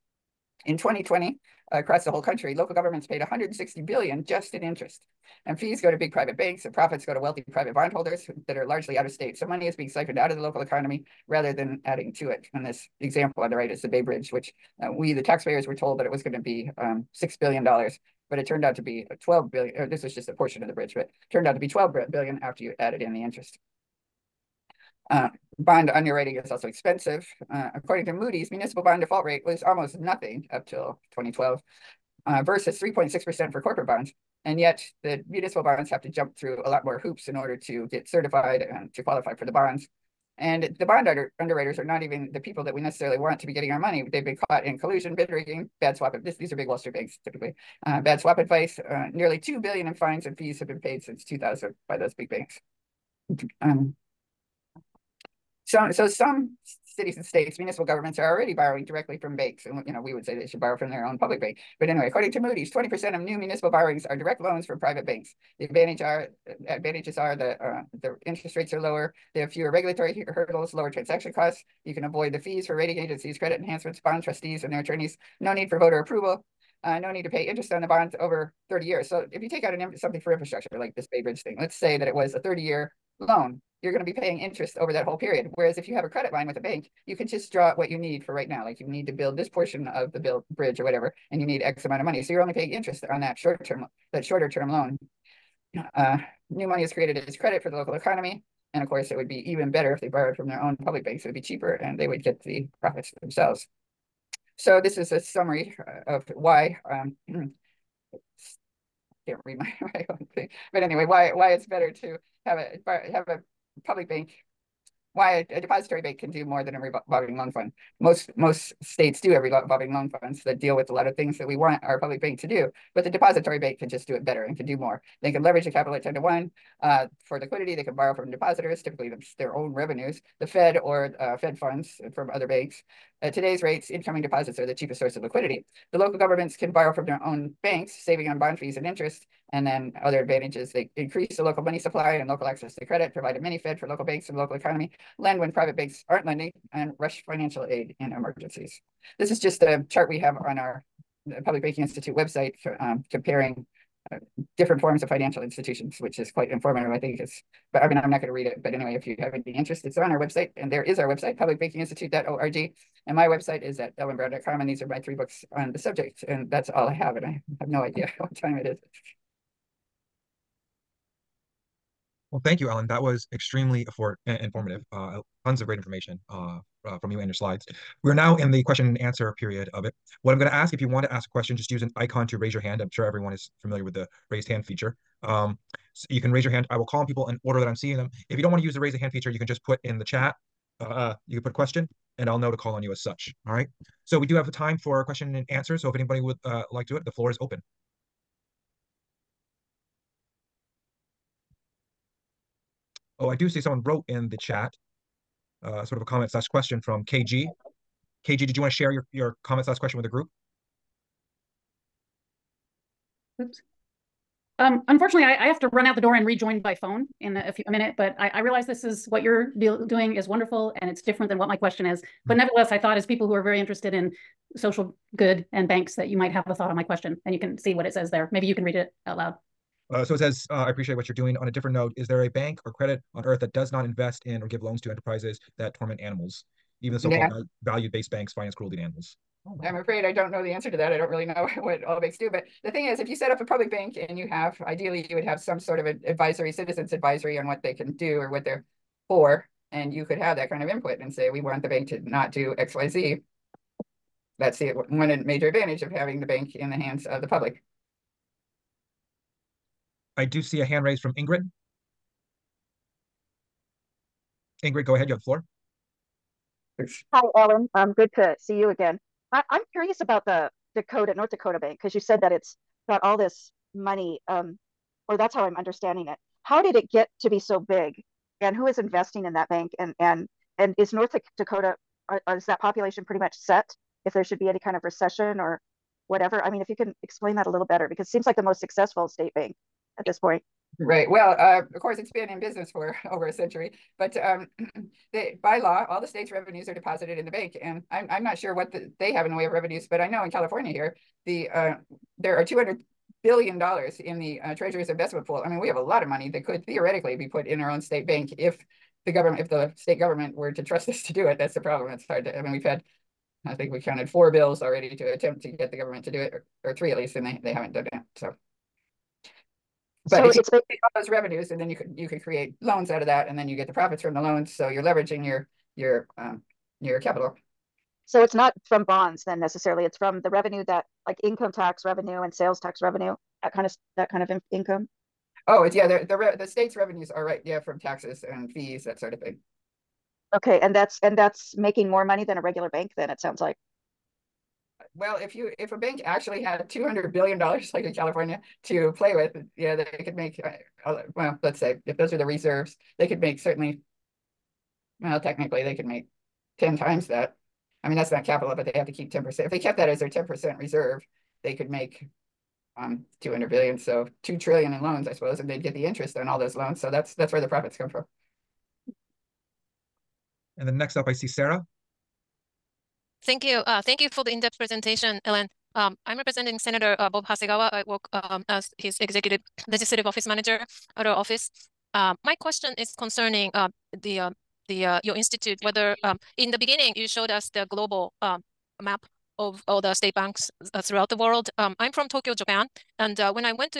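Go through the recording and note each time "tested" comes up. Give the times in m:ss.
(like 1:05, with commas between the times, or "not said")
not said.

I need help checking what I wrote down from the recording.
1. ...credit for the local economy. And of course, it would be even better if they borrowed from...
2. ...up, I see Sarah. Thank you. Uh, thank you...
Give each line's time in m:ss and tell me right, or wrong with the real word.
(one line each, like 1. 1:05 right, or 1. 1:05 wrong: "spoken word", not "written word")
1. 1:37 right
2. 6:10 right.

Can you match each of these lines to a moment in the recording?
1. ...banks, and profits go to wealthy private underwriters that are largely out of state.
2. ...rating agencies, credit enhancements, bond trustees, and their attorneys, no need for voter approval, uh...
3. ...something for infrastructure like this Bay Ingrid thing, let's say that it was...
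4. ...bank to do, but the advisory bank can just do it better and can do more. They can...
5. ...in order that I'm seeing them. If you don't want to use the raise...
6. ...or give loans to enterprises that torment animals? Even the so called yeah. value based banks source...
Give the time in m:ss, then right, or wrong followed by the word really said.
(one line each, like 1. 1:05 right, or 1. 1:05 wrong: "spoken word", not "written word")
1. 0:06 wrong: "bondholders", not "underwriters"
2. 1:12 right
3. 1:19 wrong: "Bridge", not "Ingrid"
4. 2:02 wrong: "depository", not "advisory"
5. 3:07 right
6. 3:54 wrong: "finance", not "source".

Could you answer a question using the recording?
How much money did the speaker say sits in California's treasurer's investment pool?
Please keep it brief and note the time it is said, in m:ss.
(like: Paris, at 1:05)
200 billion dollars, at 5:02.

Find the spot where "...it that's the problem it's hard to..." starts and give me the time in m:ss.
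5:11.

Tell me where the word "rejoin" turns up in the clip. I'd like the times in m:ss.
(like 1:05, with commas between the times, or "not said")
3:36.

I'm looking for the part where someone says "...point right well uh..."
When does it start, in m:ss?
4:50.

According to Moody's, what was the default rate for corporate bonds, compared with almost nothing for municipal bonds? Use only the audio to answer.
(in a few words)
3.6%.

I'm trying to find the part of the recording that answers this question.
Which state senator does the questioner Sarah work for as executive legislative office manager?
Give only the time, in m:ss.
6:17.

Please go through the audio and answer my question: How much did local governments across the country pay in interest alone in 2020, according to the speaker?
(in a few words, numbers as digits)
160 billion.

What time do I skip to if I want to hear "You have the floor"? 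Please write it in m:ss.
4:25.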